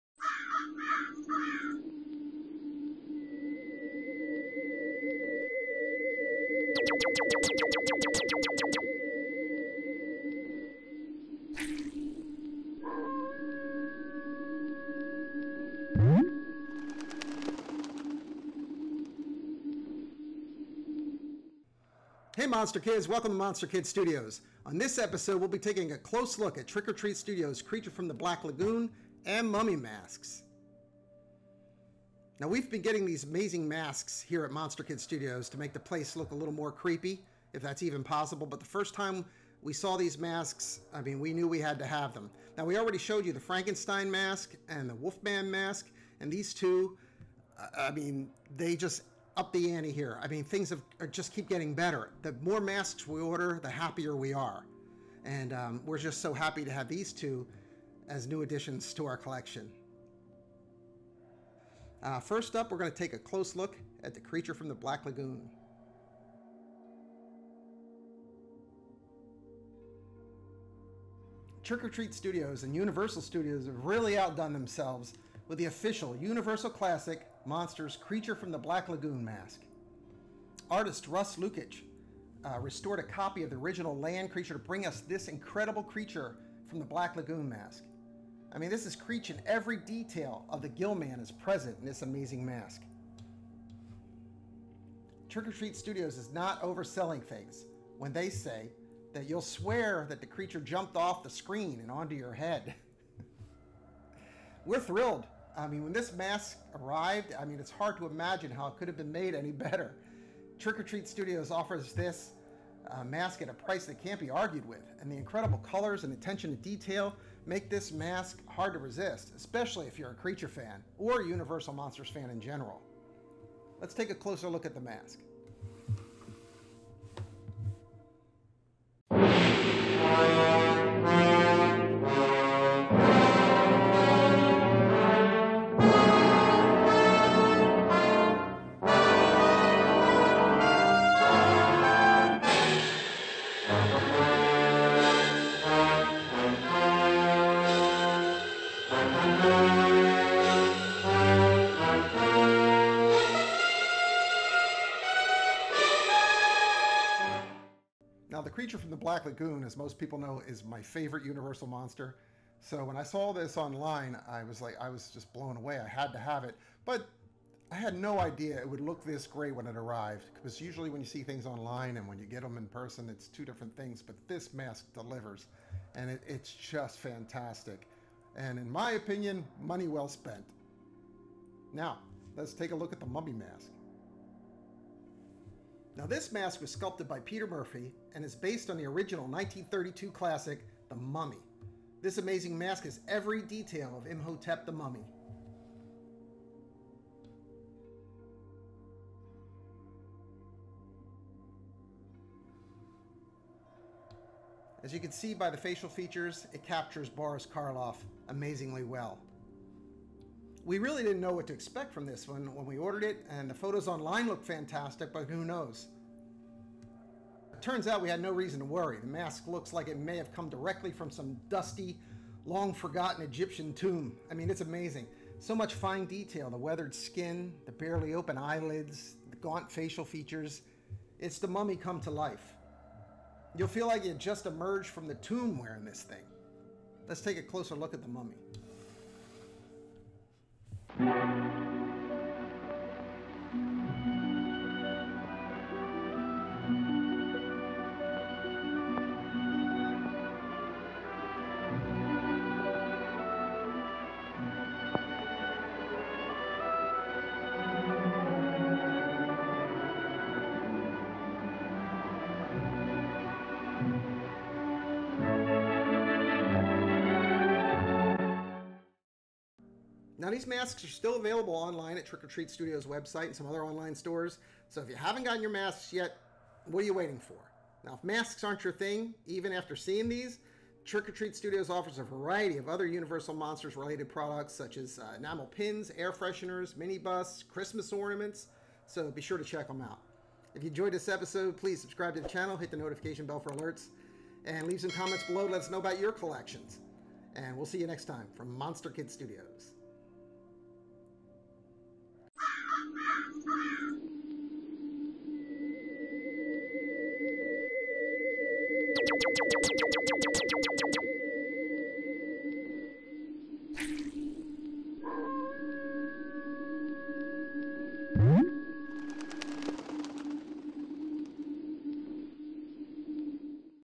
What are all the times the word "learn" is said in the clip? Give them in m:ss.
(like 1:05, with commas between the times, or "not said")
not said.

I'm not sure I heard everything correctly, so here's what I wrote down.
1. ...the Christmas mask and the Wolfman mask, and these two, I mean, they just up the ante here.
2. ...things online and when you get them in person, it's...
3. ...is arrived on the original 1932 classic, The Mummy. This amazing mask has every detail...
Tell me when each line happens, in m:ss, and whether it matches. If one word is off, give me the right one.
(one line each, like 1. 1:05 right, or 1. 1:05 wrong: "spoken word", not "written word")
1. 0:43 wrong: "Frankenstein", not "Christmas"
2. 2:51 right
3. 3:08 wrong: "based", not "arrived".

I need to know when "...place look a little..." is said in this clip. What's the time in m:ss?
0:35.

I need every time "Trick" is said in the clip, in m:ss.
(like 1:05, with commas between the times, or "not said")
0:26, 1:11, 1:35, 1:50, 4:32, 4:40.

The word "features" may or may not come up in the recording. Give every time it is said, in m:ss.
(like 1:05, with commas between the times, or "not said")
3:25, 3:50.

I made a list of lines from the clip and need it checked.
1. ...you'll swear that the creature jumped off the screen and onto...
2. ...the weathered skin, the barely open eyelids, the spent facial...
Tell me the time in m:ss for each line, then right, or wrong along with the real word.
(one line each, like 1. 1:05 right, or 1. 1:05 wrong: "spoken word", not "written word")
1. 1:39 right
2. 3:46 wrong: "gaunt", not "spent".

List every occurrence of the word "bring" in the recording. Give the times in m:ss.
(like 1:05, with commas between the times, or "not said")
1:24.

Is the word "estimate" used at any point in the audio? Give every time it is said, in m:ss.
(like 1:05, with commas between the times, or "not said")
not said.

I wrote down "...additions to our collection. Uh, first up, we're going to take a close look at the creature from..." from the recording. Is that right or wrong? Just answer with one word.
right.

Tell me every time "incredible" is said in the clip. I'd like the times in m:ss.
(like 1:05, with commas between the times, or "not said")
1:25, 1:55.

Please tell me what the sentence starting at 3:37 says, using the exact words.
It turns out we had no reason to worry.